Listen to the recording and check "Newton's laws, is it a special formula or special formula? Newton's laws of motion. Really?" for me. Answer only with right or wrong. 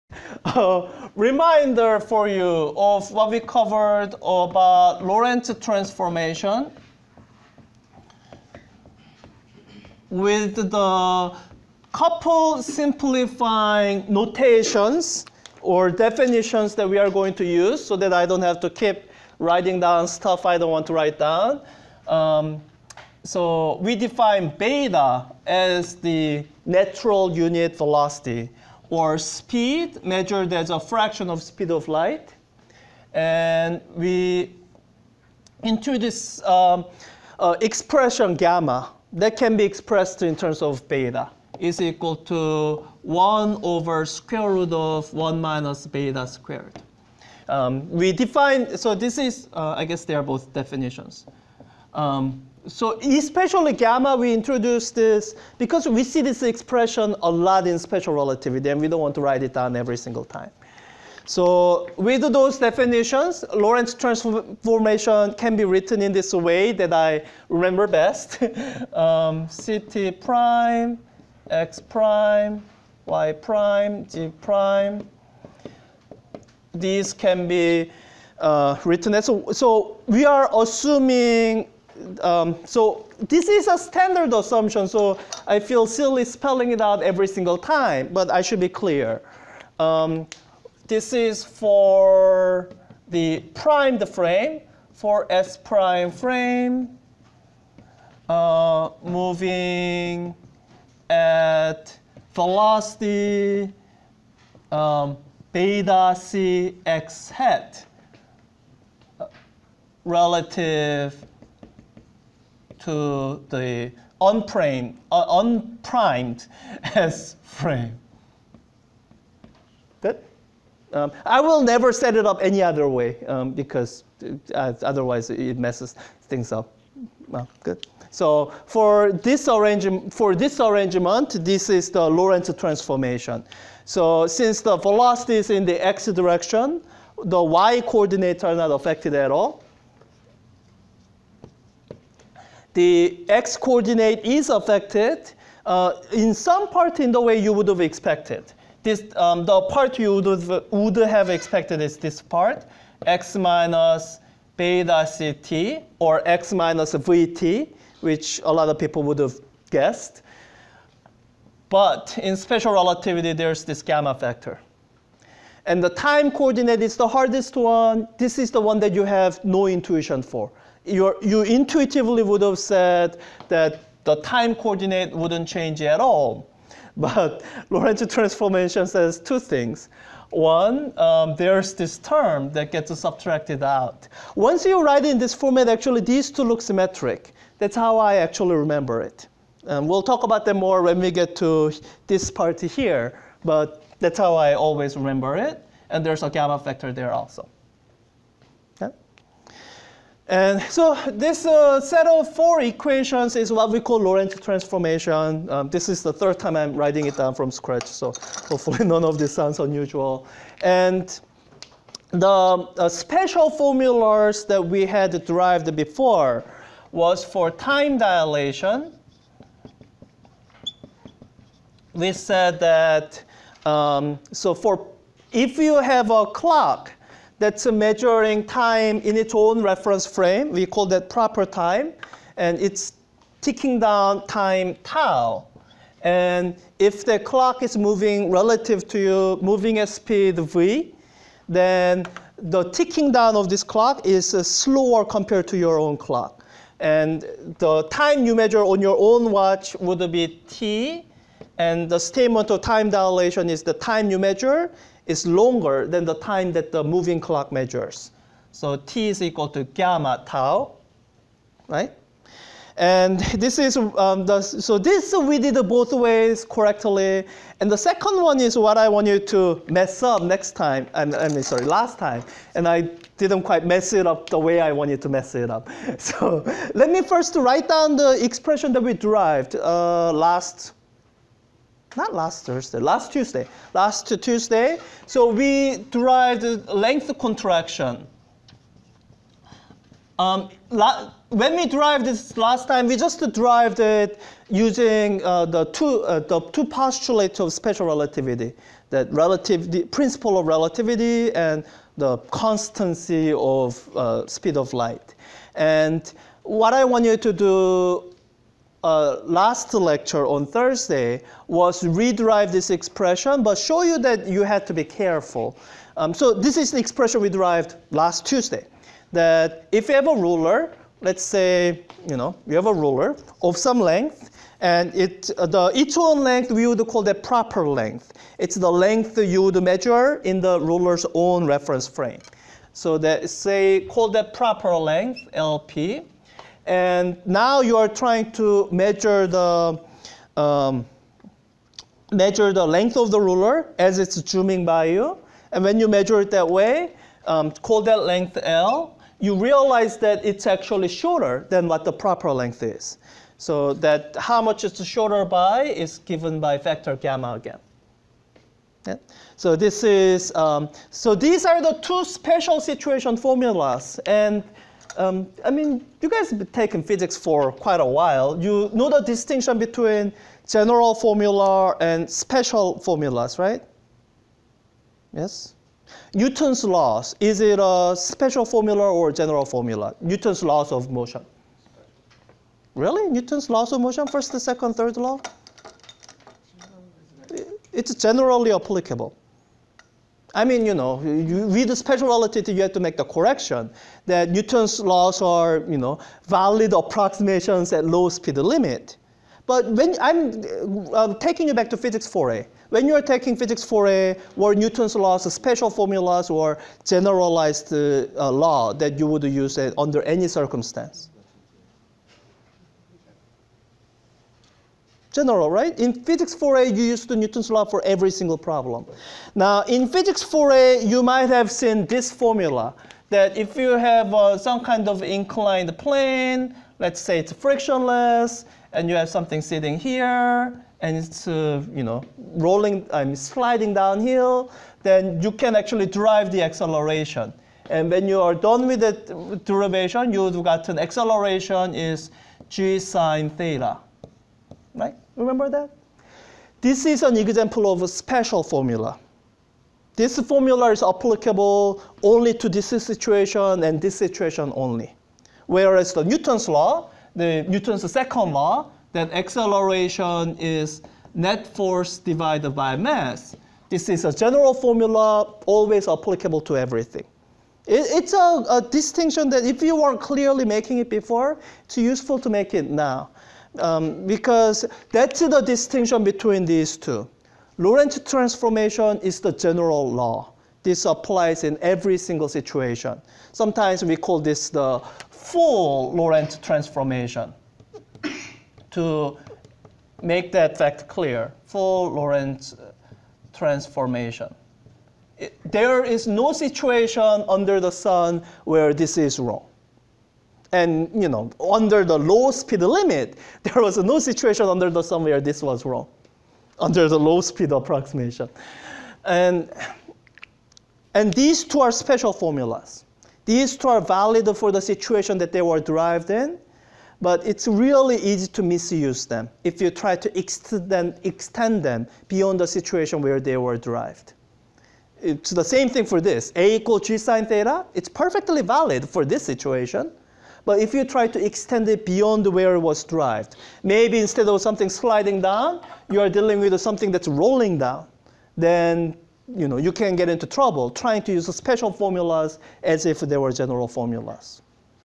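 wrong.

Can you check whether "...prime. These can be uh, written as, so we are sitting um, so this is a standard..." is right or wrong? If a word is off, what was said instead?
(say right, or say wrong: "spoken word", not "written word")
wrong: "assuming", not "sitting".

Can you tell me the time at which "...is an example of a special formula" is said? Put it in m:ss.
7:26.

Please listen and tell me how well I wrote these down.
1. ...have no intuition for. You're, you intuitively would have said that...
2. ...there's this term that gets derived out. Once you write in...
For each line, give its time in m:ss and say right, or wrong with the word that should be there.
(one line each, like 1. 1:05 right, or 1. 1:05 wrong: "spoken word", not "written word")
1. 2:49 right
2. 3:01 wrong: "subtracted", not "derived".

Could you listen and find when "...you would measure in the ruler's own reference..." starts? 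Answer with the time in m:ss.
5:29.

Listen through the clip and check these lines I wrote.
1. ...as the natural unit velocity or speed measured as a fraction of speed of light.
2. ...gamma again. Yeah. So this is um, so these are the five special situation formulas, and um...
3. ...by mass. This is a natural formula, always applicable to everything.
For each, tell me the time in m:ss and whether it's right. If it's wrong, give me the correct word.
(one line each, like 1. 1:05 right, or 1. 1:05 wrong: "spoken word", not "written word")
1. 0:25 right
2. 5:56 wrong: "two", not "five"
3. 7:42 wrong: "general", not "natural".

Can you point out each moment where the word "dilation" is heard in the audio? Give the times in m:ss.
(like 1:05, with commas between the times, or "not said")
3:37, 4:12.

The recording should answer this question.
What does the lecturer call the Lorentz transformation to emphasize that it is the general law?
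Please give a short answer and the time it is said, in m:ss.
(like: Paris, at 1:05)
full Lorentz transformation, at 8:05.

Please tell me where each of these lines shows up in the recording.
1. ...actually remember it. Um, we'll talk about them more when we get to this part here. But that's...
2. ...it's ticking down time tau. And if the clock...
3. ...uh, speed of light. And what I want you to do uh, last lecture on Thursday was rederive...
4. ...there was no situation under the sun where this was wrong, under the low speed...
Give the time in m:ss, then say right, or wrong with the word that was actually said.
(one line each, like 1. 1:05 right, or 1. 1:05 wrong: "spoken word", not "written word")
1. 3:08 right
2. 3:52 right
3. 5:03 right
4. 8:23 right.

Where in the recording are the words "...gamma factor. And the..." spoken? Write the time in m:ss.
2:43.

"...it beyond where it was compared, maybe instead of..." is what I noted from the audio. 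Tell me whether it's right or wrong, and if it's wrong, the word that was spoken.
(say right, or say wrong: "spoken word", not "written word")
wrong: "derived", not "compared".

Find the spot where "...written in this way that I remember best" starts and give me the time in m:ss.
1:05.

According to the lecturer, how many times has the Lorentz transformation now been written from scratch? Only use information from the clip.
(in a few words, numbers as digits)
3.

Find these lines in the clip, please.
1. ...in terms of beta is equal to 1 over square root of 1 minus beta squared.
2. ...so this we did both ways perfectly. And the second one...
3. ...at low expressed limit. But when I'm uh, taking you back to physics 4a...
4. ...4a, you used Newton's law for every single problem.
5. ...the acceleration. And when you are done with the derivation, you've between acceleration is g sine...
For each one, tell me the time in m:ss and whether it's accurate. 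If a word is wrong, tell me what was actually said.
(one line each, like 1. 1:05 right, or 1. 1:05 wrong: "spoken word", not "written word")
1. 0:40 right
2. 4:24 wrong: "correctly", not "perfectly"
3. 6:37 wrong: "speed", not "expressed"
4. 6:56 right
5. 7:16 wrong: "gotten", not "between".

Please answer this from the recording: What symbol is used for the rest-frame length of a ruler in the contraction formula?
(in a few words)
LP.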